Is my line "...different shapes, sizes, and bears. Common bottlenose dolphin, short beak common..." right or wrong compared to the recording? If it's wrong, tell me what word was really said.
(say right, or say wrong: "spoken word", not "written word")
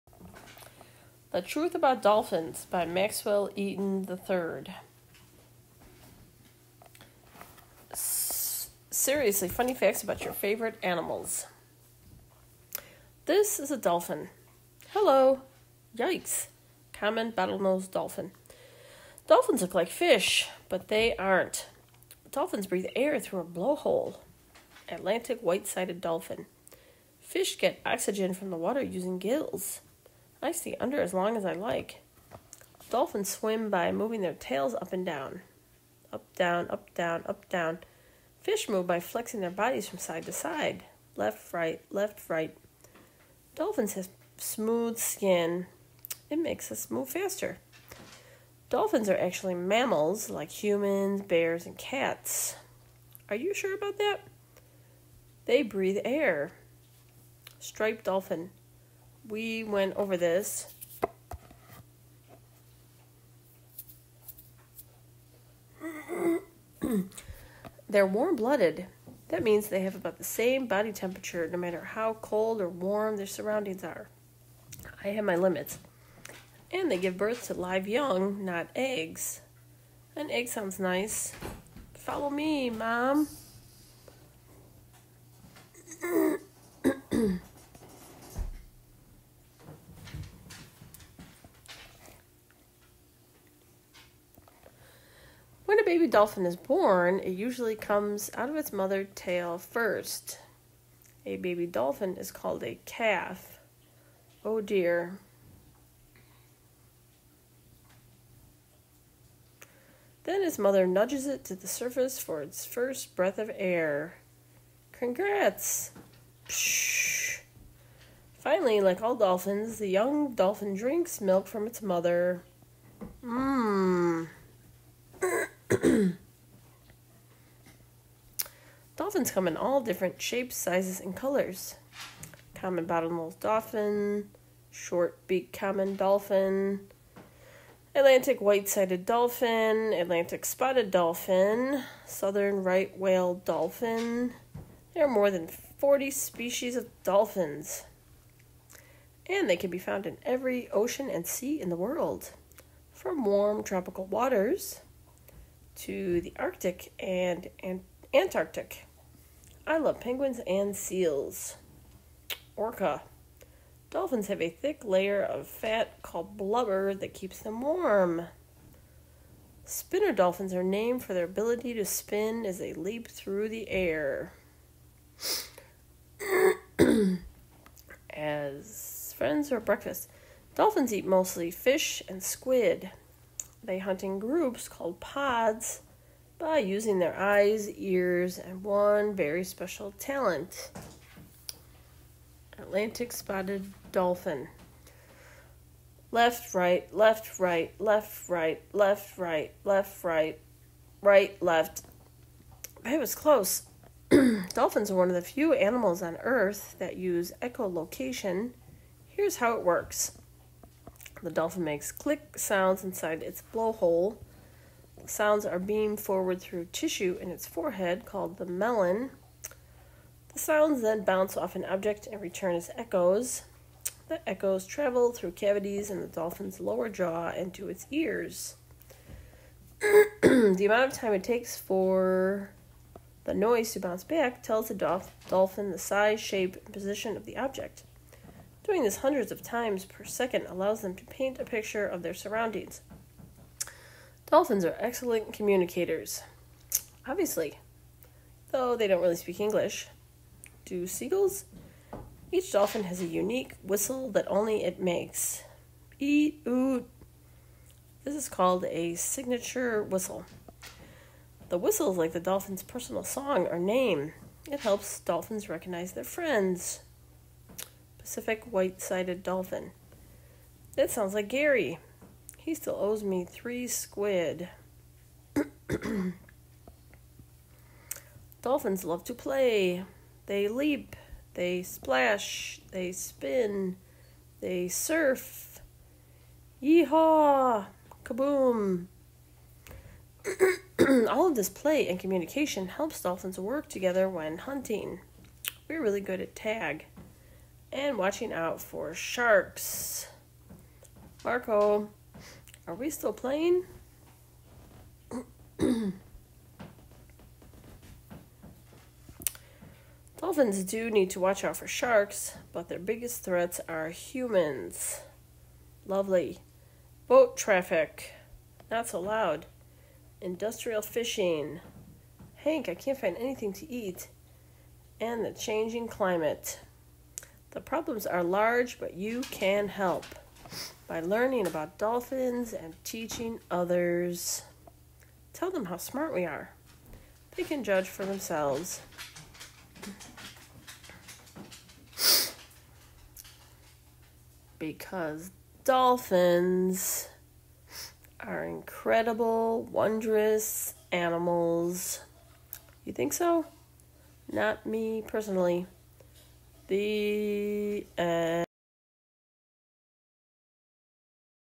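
wrong: "colors", not "bears".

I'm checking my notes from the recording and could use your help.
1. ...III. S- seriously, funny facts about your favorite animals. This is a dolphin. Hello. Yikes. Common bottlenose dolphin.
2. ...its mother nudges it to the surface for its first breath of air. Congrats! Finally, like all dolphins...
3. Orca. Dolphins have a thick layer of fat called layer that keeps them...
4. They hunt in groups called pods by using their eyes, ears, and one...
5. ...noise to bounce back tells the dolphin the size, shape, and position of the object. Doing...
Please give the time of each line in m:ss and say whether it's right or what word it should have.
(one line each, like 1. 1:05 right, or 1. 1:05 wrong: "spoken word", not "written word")
1. 0:04 right
2. 1:50 right
3. 2:42 wrong: "blubber", not "layer"
4. 3:03 right
5. 3:53 right.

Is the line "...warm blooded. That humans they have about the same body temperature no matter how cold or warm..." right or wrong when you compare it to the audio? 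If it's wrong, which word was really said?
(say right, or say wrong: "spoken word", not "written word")
wrong: "means", not "humans".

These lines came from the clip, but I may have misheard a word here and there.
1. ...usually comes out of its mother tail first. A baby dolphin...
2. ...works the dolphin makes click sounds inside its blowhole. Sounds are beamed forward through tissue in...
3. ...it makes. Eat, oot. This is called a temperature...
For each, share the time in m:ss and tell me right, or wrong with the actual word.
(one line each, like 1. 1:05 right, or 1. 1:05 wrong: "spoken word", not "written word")
1. 1:37 right
2. 3:29 right
3. 4:14 wrong: "signature", not "temperature".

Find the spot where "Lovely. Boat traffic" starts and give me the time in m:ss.
5:15.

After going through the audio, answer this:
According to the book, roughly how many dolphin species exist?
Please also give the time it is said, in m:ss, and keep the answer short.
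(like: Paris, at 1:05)
More than 40, at 2:25.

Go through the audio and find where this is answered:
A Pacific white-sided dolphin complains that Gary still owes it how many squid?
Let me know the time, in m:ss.
4:33.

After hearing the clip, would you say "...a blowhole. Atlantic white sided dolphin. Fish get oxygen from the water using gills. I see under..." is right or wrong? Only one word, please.
right.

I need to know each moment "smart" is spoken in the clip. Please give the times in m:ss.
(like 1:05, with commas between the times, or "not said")
5:35.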